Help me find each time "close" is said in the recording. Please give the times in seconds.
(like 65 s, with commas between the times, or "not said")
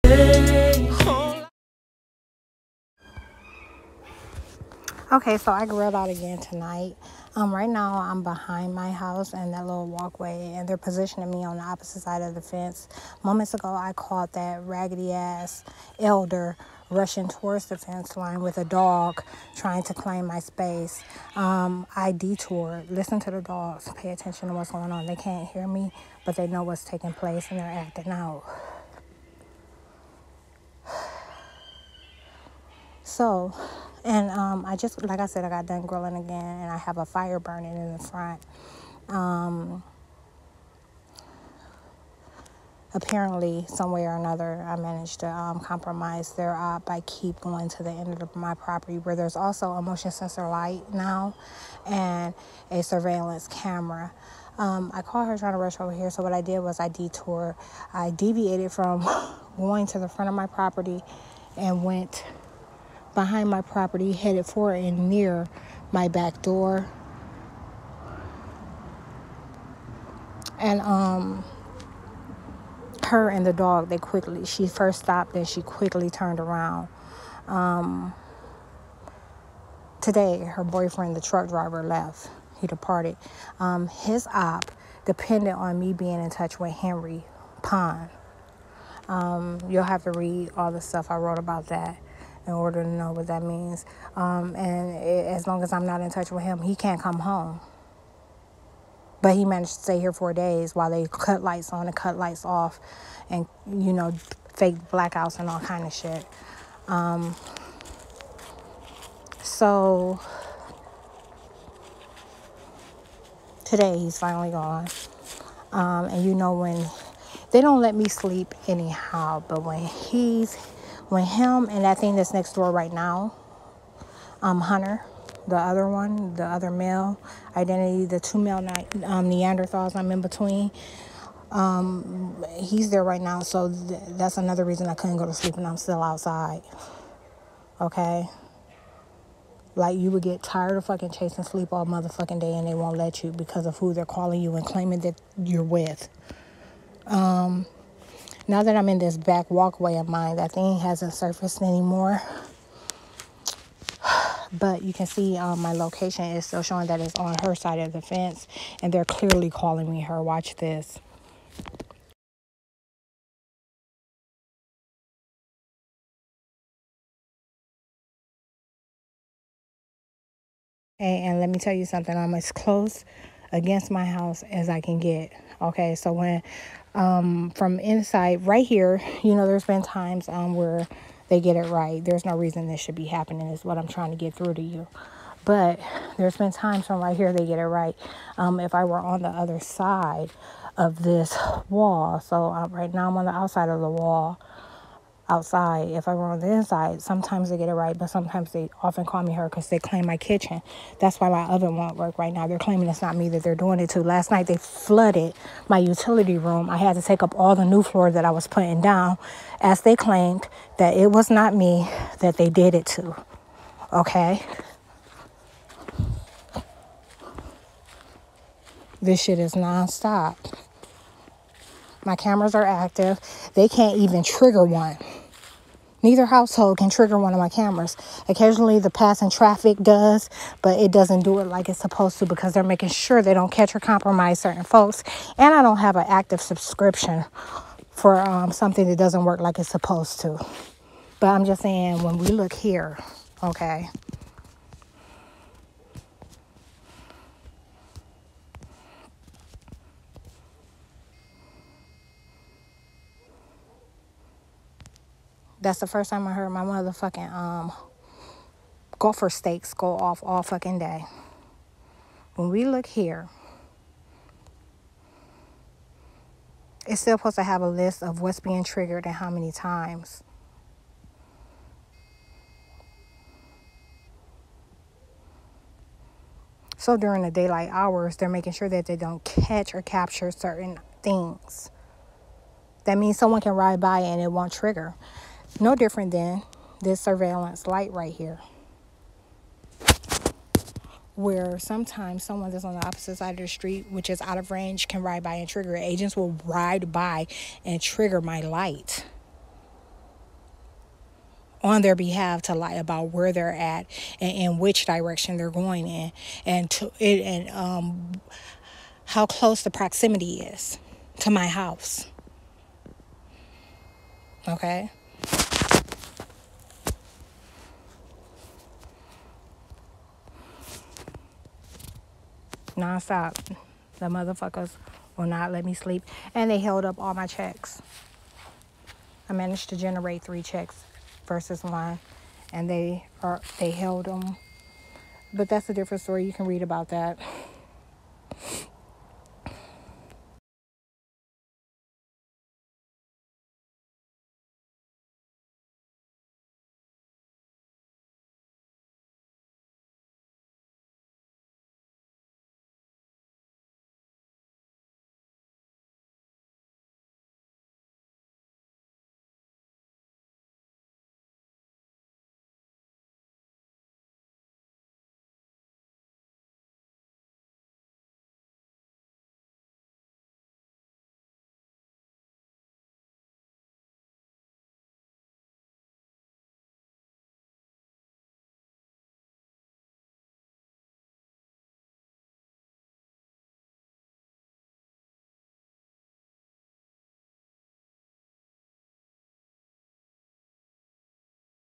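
172 s, 309 s.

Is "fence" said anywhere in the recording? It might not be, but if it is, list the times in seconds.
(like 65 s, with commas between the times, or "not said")
12 s, 17 s, 158 s.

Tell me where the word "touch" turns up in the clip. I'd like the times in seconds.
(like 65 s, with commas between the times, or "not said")
86 s, 96 s.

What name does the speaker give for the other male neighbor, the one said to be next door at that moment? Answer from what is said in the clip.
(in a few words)
Hunter.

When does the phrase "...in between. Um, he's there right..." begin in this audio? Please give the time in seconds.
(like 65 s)
130 s.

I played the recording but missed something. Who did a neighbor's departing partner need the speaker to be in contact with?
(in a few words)
Henry Pond.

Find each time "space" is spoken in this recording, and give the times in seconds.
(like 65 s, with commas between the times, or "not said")
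20 s.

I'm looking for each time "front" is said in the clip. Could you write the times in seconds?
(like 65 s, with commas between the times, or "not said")
37 s, 60 s.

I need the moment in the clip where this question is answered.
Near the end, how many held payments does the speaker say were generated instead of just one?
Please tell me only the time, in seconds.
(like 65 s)
330 s.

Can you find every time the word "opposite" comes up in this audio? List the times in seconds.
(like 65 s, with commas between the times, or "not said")
11 s, 292 s.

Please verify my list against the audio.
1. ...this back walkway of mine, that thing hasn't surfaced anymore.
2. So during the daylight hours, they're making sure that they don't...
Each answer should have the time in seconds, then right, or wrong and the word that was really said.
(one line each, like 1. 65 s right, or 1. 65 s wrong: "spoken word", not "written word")
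1. 148 s right
2. 276 s right.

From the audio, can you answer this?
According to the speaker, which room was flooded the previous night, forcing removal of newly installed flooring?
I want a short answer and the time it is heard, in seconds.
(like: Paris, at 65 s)
utility room, at 205 s.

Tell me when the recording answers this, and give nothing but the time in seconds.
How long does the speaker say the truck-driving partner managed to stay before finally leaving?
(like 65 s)
100 s.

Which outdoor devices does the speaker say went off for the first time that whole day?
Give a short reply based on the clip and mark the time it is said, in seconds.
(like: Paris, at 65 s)
gopher stakes, at 258 s.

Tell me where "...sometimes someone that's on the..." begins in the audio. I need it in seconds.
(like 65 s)
291 s.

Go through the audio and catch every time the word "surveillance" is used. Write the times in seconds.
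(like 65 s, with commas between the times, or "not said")
52 s, 287 s.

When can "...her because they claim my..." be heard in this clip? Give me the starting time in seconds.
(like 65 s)
199 s.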